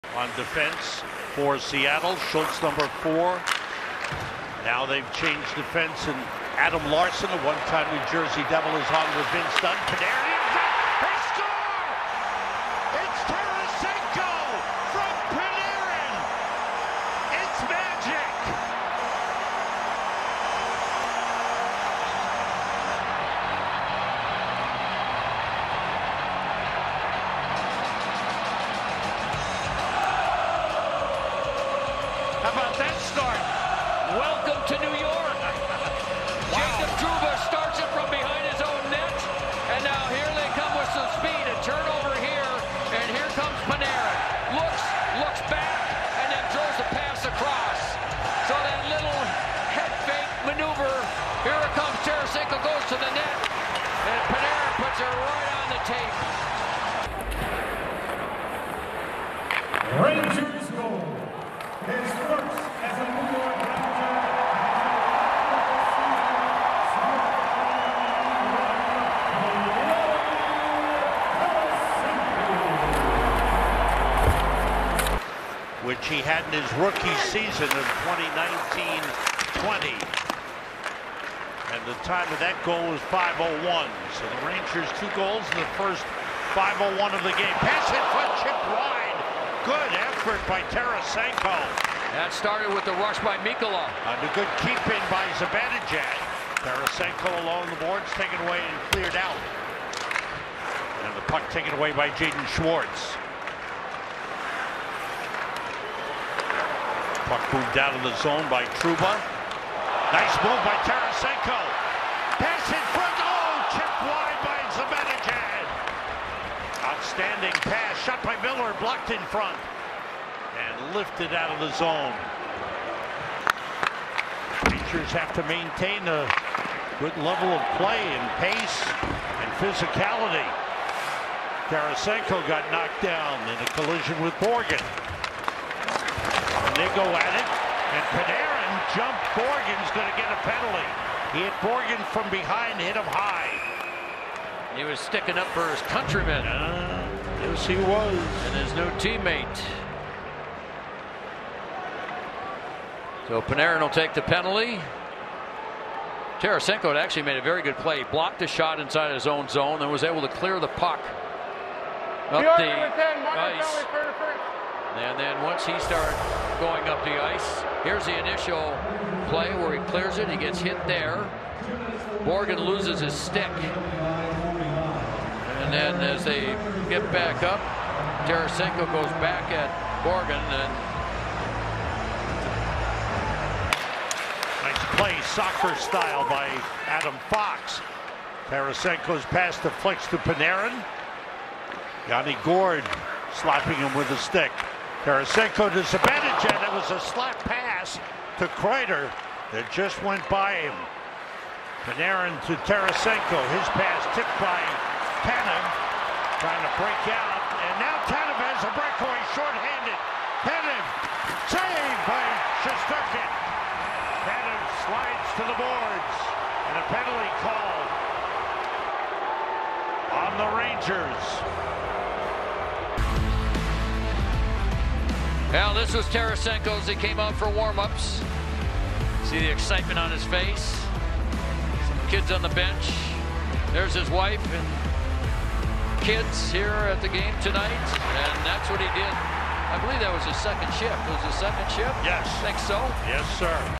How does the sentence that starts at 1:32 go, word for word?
That started with the rush by Mikola.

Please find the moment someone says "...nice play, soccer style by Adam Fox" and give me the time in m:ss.
3:04.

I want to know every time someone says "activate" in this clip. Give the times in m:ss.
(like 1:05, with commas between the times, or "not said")
not said.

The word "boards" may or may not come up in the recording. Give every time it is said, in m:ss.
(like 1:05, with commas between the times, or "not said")
1:37, 3:35.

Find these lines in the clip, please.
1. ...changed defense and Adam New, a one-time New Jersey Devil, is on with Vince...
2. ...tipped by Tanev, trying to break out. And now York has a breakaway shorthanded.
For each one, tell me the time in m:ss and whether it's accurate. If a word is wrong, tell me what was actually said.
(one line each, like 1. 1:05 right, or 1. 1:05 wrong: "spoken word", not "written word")
1. 0:05 wrong: "Larsson", not "New"
2. 3:24 wrong: "Tanev", not "York".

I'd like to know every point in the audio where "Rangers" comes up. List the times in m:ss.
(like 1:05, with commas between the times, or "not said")
1:24, 2:04, 3:40.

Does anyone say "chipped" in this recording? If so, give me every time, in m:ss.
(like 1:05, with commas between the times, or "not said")
1:28, 1:53.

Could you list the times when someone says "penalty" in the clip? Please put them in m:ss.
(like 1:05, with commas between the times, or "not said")
2:20, 2:34, 3:36.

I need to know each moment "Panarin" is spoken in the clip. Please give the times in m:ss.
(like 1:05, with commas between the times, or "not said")
2:18, 2:33, 3:10, 3:21.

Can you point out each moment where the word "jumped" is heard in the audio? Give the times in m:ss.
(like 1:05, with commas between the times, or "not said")
2:18.